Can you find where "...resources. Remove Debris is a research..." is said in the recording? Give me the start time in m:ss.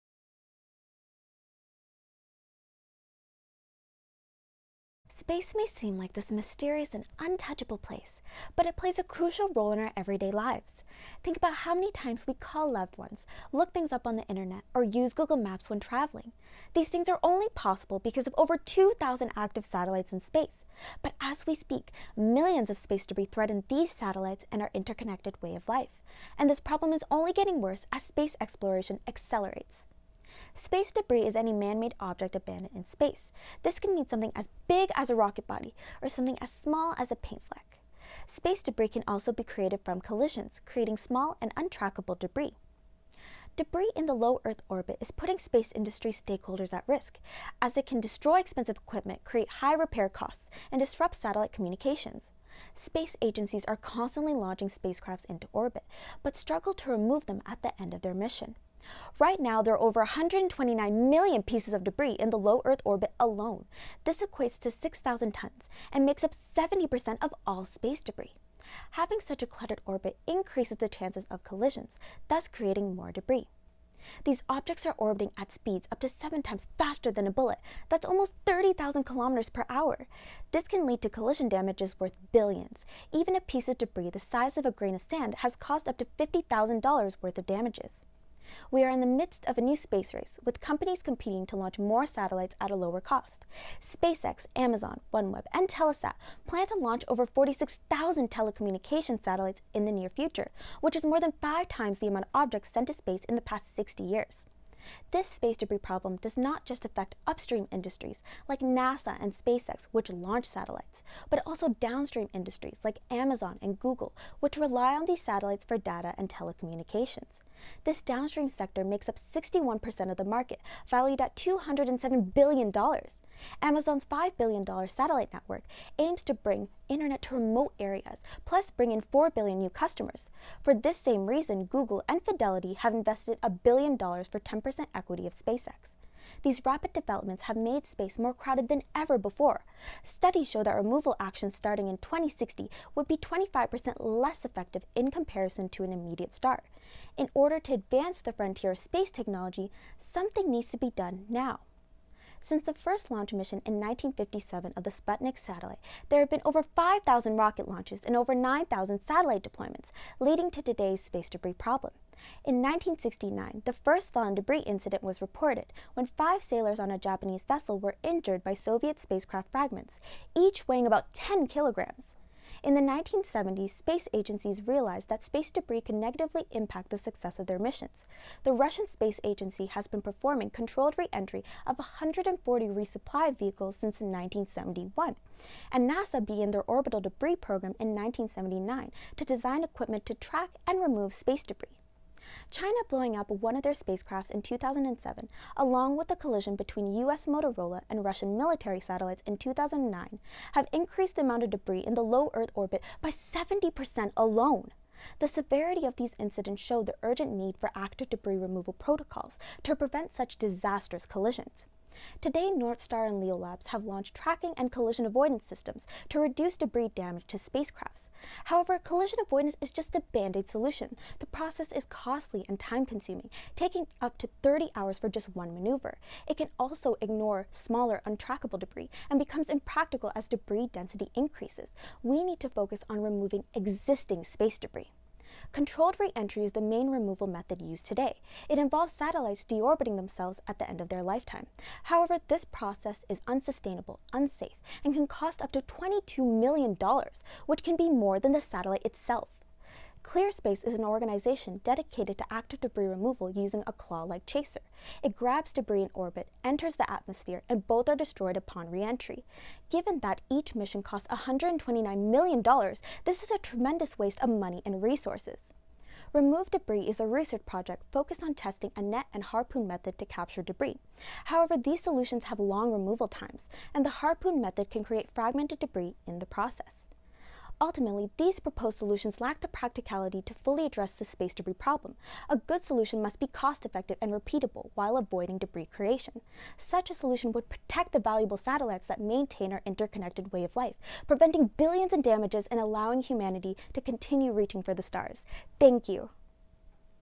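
4:24.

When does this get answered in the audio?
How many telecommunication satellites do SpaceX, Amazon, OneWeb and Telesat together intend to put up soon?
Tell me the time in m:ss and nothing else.
1:37.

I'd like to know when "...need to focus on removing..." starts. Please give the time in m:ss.
3:52.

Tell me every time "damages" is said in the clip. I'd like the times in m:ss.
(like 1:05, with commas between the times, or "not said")
1:21, 1:27, 3:36, 4:52.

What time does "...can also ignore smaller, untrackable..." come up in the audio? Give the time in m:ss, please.
3:46.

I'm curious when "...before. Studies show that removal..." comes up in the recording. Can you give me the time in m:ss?
2:19.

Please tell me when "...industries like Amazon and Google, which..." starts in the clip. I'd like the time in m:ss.
1:52.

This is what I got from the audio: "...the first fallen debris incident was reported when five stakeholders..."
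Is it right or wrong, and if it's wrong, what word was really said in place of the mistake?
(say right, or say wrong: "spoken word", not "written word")
wrong: "sailors", not "stakeholders".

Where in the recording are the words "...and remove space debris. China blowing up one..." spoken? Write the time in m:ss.
3:10.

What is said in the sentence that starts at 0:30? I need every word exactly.
Space debris is any man made object abandoned in space.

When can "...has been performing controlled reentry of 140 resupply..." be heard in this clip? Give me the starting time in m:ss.
2:59.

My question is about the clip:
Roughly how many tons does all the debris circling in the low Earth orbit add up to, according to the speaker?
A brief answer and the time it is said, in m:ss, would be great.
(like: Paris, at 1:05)
6,000 tons, at 1:04.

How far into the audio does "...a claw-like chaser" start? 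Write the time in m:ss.
4:13.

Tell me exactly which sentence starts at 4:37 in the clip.
Ultimately, these proposed solutions lack the practicality to fully address the space debris problem.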